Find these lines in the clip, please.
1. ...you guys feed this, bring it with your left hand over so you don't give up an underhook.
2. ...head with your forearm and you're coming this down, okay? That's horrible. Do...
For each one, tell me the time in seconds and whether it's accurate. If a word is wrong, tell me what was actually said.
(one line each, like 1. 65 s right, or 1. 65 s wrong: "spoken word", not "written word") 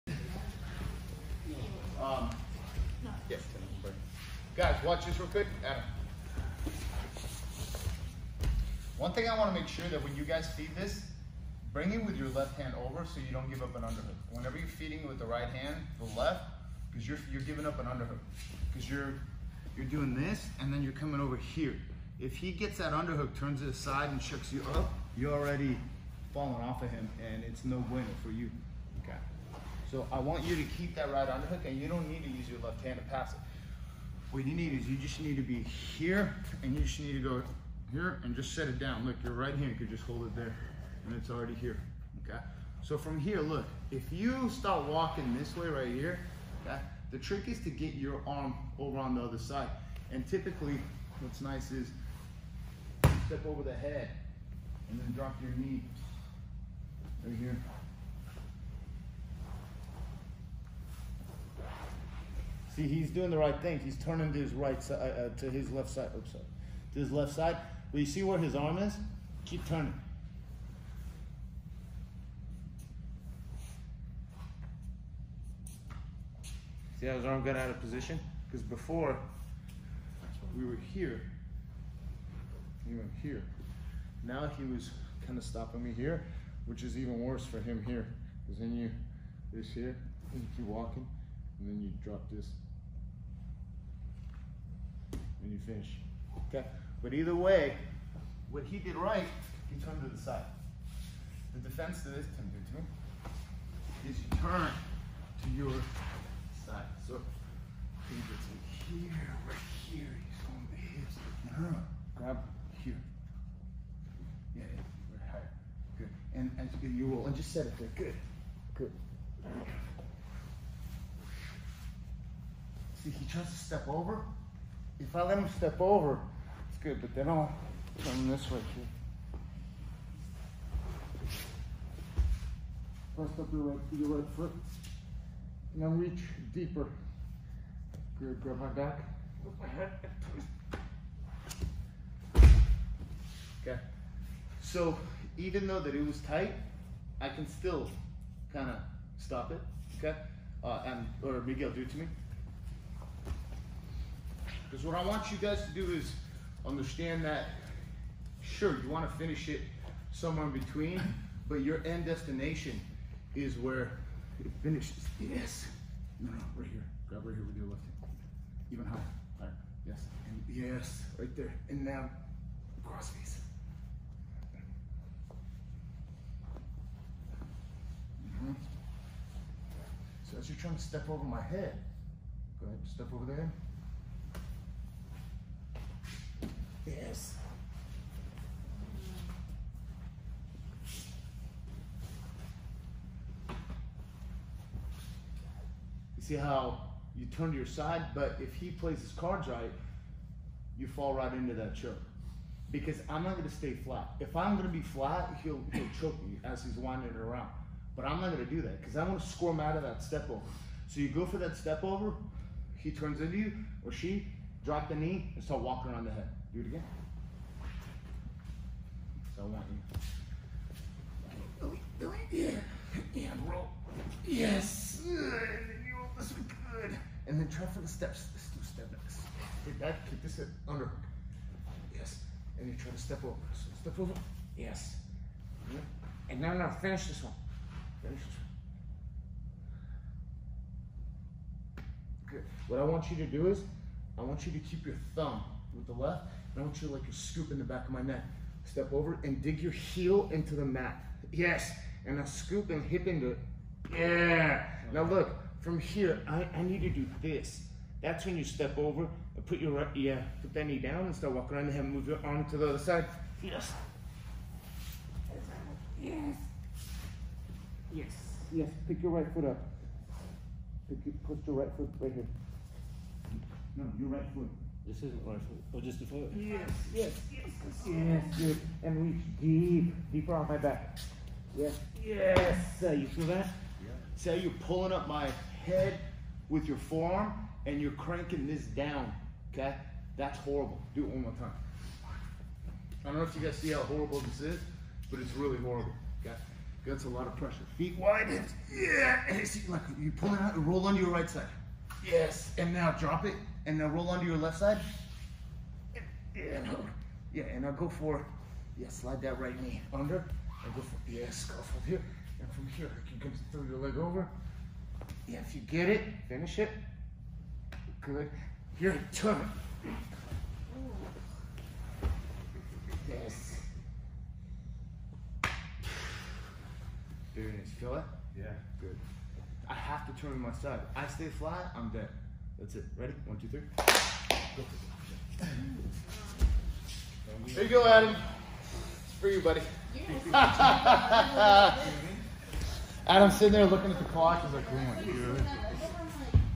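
1. 10 s right
2. 285 s wrong: "cranking", not "coming".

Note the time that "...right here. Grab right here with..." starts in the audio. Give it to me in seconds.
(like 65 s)
166 s.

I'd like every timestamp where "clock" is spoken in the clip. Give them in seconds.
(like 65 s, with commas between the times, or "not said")
344 s.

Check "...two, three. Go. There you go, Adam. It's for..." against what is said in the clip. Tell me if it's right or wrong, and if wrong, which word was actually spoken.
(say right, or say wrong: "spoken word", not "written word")
right.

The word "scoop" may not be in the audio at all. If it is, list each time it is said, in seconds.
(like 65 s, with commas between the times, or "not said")
247 s, 252 s.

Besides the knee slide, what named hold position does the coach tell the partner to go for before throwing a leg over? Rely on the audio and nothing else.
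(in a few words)
Scarf hold.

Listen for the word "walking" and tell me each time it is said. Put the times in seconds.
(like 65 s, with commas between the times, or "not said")
44 s, 90 s, 215 s, 261 s.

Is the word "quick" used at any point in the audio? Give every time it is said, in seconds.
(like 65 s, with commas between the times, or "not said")
5 s.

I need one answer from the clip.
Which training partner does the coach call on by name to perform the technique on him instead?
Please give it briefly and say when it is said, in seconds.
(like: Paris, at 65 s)
Miguel, at 151 s.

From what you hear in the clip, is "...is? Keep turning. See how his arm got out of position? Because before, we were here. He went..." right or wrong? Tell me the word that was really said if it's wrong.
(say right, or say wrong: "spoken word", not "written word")
right.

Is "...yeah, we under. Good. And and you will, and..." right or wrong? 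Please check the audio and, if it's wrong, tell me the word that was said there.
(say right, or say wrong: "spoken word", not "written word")
wrong: "higher", not "under".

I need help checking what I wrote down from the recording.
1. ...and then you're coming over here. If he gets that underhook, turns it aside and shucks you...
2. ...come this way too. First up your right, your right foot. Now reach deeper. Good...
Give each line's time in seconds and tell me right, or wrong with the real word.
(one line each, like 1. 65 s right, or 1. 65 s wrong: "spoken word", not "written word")
1. 20 s right
2. 128 s right.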